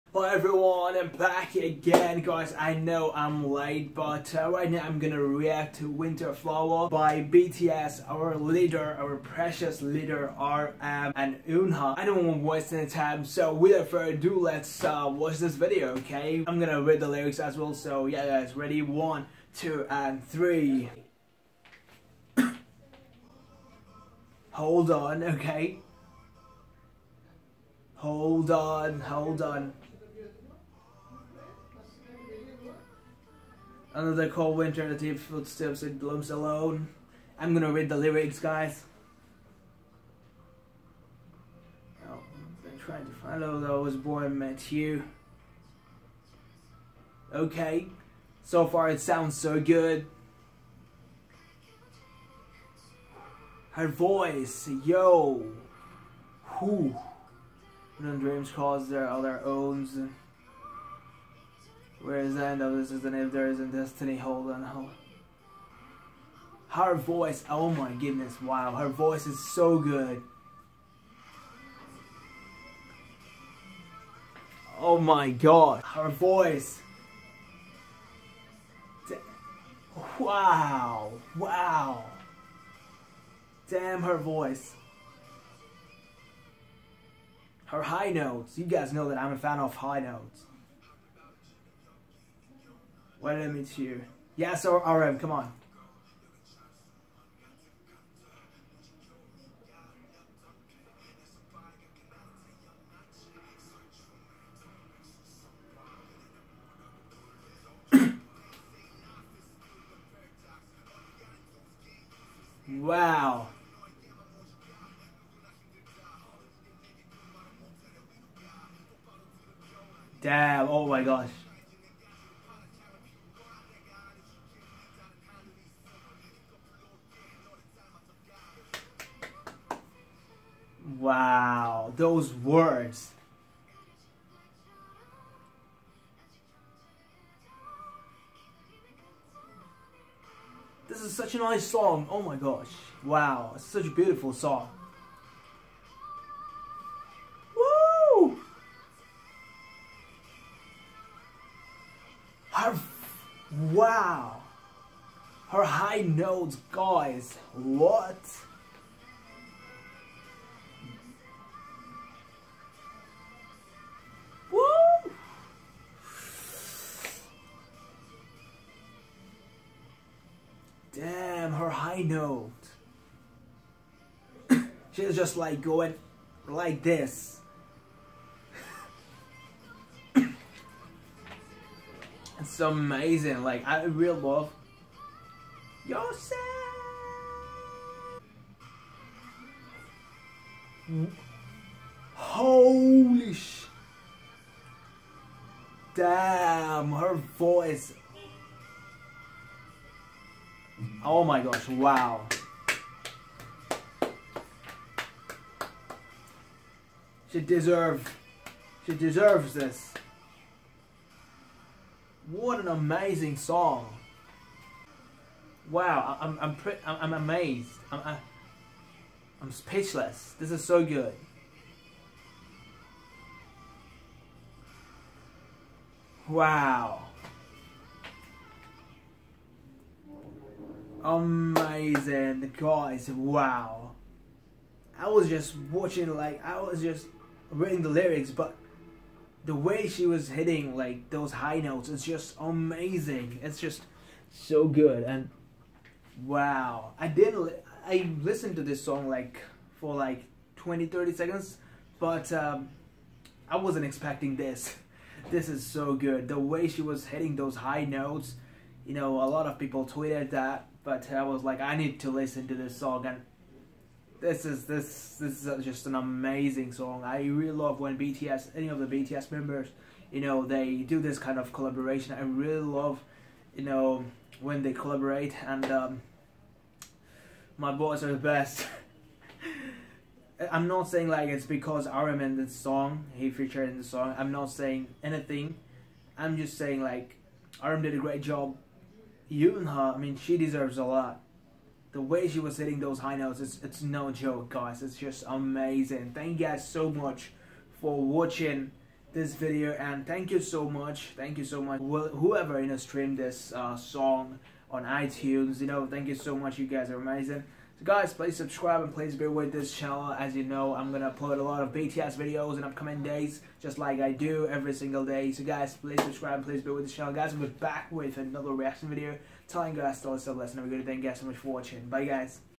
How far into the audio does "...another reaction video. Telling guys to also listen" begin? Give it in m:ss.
5:18.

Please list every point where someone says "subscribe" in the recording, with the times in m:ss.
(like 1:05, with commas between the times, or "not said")
5:08, 5:16.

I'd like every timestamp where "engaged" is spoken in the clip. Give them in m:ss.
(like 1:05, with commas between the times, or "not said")
not said.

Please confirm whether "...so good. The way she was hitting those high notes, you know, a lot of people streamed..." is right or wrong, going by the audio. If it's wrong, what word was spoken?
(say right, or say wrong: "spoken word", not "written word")
wrong: "tweeted", not "streamed".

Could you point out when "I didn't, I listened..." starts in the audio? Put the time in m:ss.
4:06.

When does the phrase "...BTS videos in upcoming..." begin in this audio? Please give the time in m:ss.
5:11.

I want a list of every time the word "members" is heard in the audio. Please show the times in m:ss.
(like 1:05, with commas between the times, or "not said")
4:29.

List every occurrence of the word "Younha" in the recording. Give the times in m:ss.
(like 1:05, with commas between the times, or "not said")
0:11, 4:49.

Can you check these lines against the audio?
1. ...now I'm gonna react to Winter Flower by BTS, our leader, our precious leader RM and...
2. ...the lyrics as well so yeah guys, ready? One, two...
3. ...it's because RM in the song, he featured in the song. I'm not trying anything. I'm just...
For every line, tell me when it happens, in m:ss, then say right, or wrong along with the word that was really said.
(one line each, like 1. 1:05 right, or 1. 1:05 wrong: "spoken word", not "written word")
1. 0:04 right
2. 0:16 right
3. 4:41 wrong: "saying", not "trying".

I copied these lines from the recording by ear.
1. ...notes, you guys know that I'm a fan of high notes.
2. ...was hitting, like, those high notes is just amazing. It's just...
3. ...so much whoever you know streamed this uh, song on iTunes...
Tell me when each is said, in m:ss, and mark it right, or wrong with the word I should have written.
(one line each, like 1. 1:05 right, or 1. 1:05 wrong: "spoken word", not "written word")
1. 1:28 right
2. 4:00 right
3. 5:01 right.